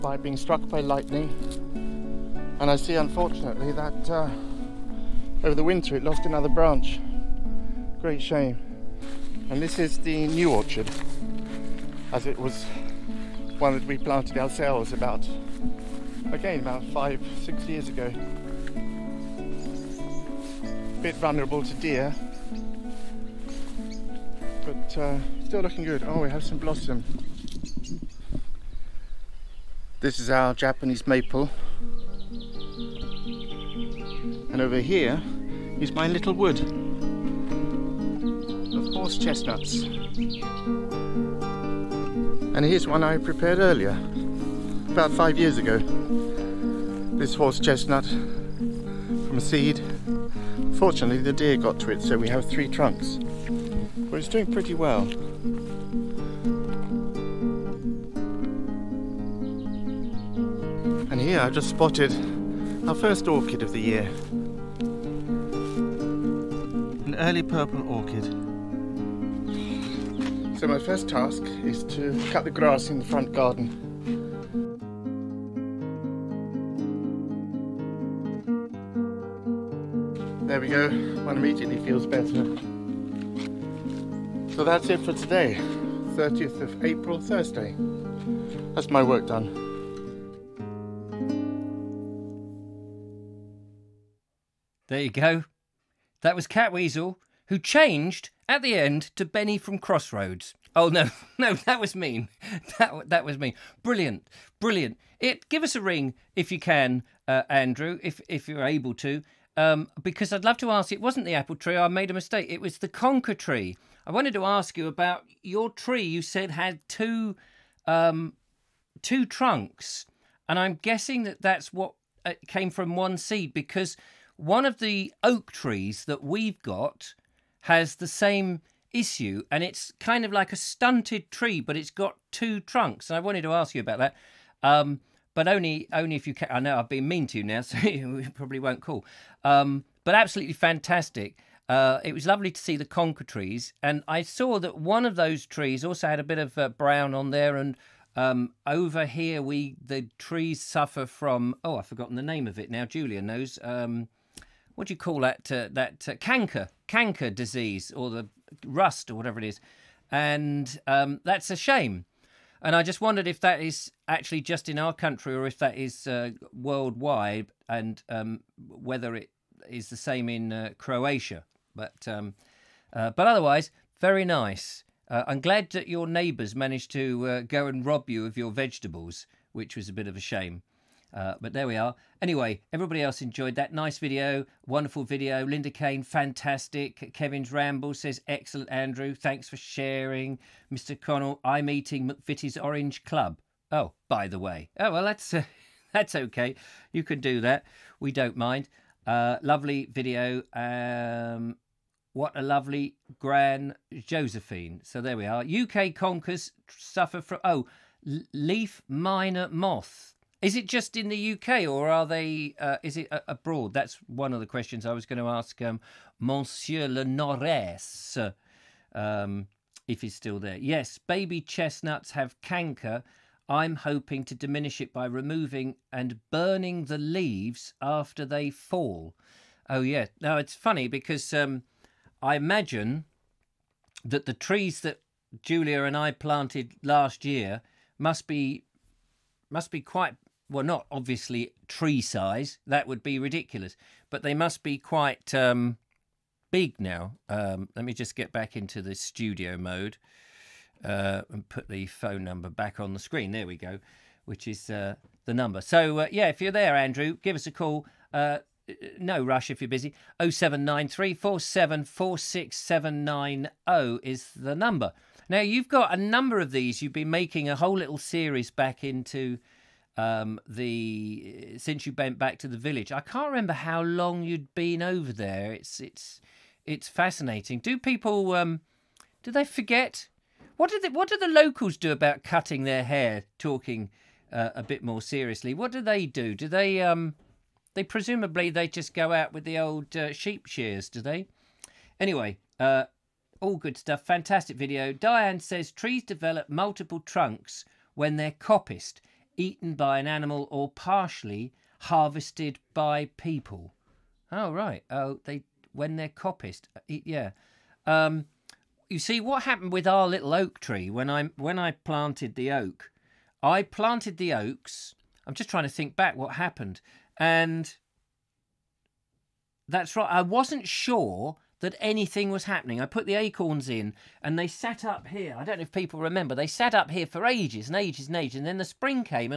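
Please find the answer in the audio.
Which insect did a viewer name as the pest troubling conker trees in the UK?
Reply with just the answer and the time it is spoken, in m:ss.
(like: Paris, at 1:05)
Leaf miner moth, at 3:28.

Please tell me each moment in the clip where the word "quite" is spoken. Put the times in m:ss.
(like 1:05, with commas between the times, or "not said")
3:59, 4:04.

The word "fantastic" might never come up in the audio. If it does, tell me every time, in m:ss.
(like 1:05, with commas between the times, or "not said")
2:20, 3:06, 4:54.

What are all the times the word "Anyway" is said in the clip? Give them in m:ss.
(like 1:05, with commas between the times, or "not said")
3:02, 4:51.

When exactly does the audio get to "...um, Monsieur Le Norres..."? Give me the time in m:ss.
3:35.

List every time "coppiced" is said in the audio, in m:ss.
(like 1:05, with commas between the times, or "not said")
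4:58, 5:06.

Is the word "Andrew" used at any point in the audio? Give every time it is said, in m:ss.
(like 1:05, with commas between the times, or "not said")
1:47, 3:08, 4:16.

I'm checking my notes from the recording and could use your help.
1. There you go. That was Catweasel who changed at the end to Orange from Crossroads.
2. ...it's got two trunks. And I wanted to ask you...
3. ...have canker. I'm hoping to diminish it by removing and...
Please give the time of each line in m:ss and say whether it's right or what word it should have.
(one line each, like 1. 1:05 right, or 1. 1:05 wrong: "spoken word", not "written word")
1. 1:34 wrong: "Benny", not "Orange"
2. 2:11 right
3. 3:42 right.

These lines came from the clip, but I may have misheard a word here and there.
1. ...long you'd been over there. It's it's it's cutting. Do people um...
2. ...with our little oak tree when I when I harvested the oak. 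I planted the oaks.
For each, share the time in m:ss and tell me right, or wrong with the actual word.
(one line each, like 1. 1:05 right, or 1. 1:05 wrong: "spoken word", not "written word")
1. 4:33 wrong: "fascinating", not "cutting"
2. 5:09 wrong: "planted", not "harvested".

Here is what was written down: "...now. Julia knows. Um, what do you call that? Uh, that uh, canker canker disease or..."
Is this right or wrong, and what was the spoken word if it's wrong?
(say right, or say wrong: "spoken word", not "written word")
right.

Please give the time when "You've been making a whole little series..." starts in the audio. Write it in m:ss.
4:26.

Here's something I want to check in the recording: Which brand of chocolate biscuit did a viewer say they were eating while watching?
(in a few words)
McVitie's Orange Club.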